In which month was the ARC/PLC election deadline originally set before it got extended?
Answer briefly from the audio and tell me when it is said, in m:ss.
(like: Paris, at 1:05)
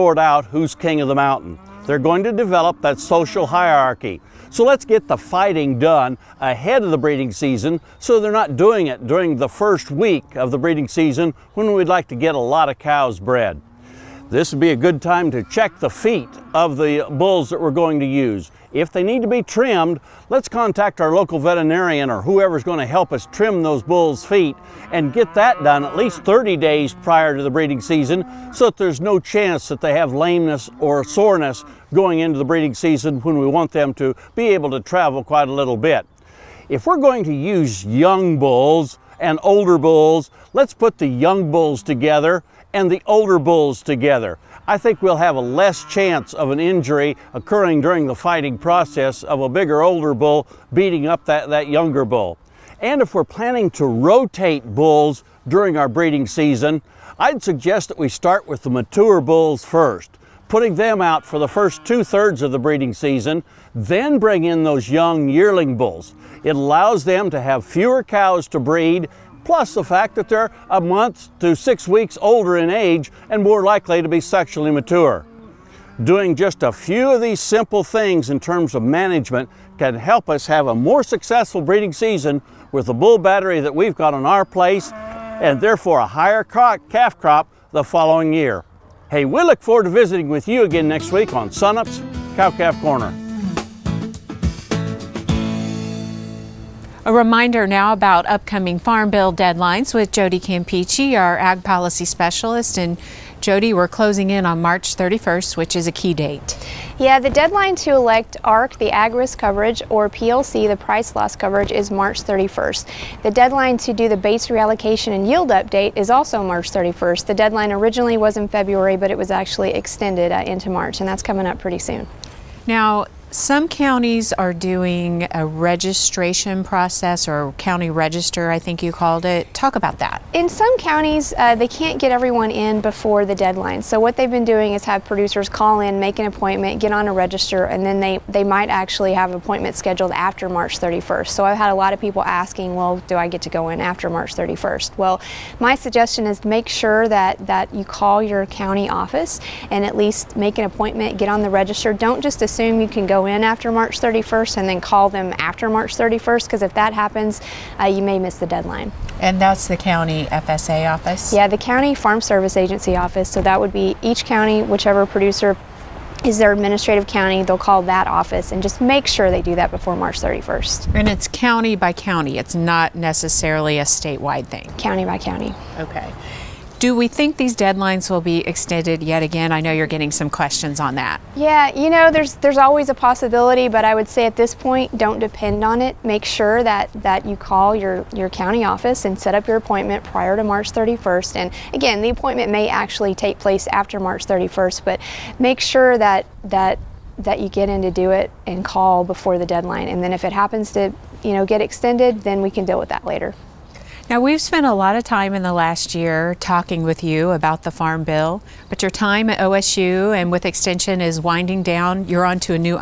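February, at 1:58.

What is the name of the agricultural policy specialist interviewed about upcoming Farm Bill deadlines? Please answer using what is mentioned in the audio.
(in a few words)
Jody Campiche.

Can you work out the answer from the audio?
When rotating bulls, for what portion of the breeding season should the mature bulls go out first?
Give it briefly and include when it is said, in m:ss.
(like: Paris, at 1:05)
first two thirds, at 1:01.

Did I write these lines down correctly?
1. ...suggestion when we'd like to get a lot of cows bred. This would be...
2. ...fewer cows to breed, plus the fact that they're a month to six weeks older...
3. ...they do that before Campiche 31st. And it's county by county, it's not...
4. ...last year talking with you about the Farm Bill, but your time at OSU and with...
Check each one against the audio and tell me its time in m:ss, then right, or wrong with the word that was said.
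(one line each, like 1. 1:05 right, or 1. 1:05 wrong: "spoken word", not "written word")
1. 0:10 wrong: "season", not "suggestion"
2. 1:07 right
3. 2:49 wrong: "March", not "Campiche"
4. 3:25 right.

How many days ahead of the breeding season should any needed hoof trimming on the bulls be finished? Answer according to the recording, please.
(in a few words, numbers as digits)
30 days.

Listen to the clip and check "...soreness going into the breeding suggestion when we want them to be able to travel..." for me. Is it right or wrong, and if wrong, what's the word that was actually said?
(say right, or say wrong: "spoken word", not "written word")
wrong: "season", not "suggestion".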